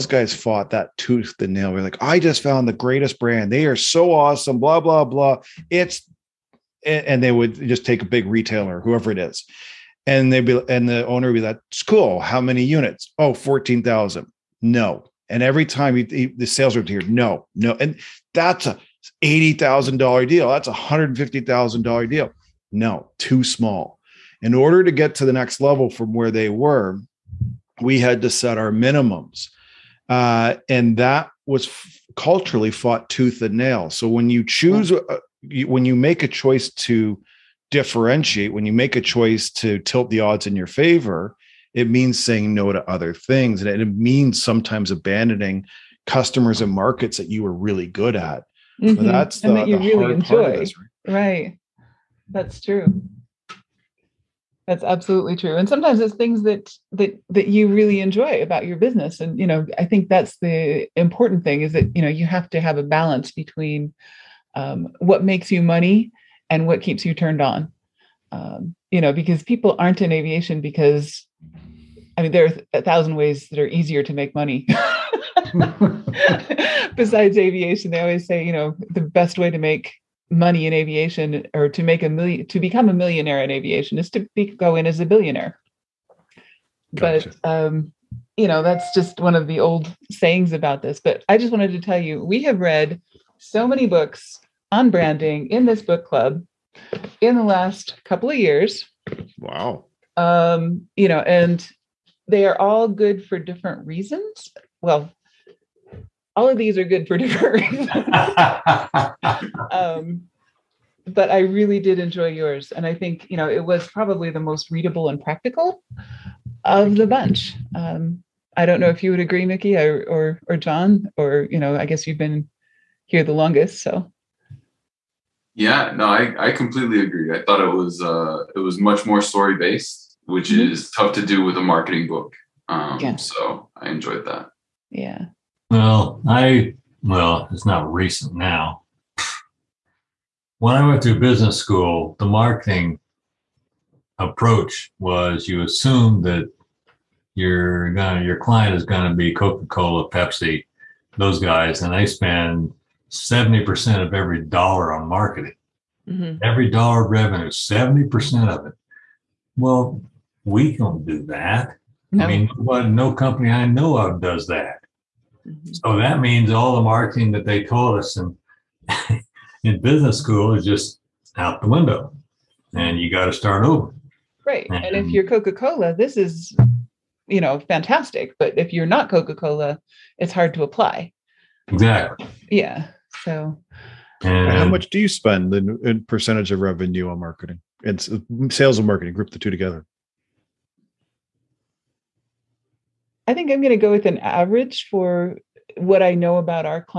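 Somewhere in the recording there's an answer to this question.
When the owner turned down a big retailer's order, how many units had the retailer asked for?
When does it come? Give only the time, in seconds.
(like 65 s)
13 s.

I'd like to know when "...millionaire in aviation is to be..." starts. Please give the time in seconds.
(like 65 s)
82 s.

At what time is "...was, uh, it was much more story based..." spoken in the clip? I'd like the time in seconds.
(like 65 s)
127 s.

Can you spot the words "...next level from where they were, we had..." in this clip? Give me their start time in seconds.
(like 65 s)
25 s.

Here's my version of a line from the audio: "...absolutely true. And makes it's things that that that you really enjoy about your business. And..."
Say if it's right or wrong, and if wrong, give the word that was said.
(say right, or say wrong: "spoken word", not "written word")
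wrong: "sometimes", not "makes".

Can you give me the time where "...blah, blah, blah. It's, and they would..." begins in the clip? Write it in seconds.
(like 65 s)
4 s.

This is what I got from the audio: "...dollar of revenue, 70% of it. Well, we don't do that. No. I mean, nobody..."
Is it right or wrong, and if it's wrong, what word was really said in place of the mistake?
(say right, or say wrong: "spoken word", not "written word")
right.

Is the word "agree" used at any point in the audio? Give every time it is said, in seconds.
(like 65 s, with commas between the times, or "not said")
119 s, 126 s.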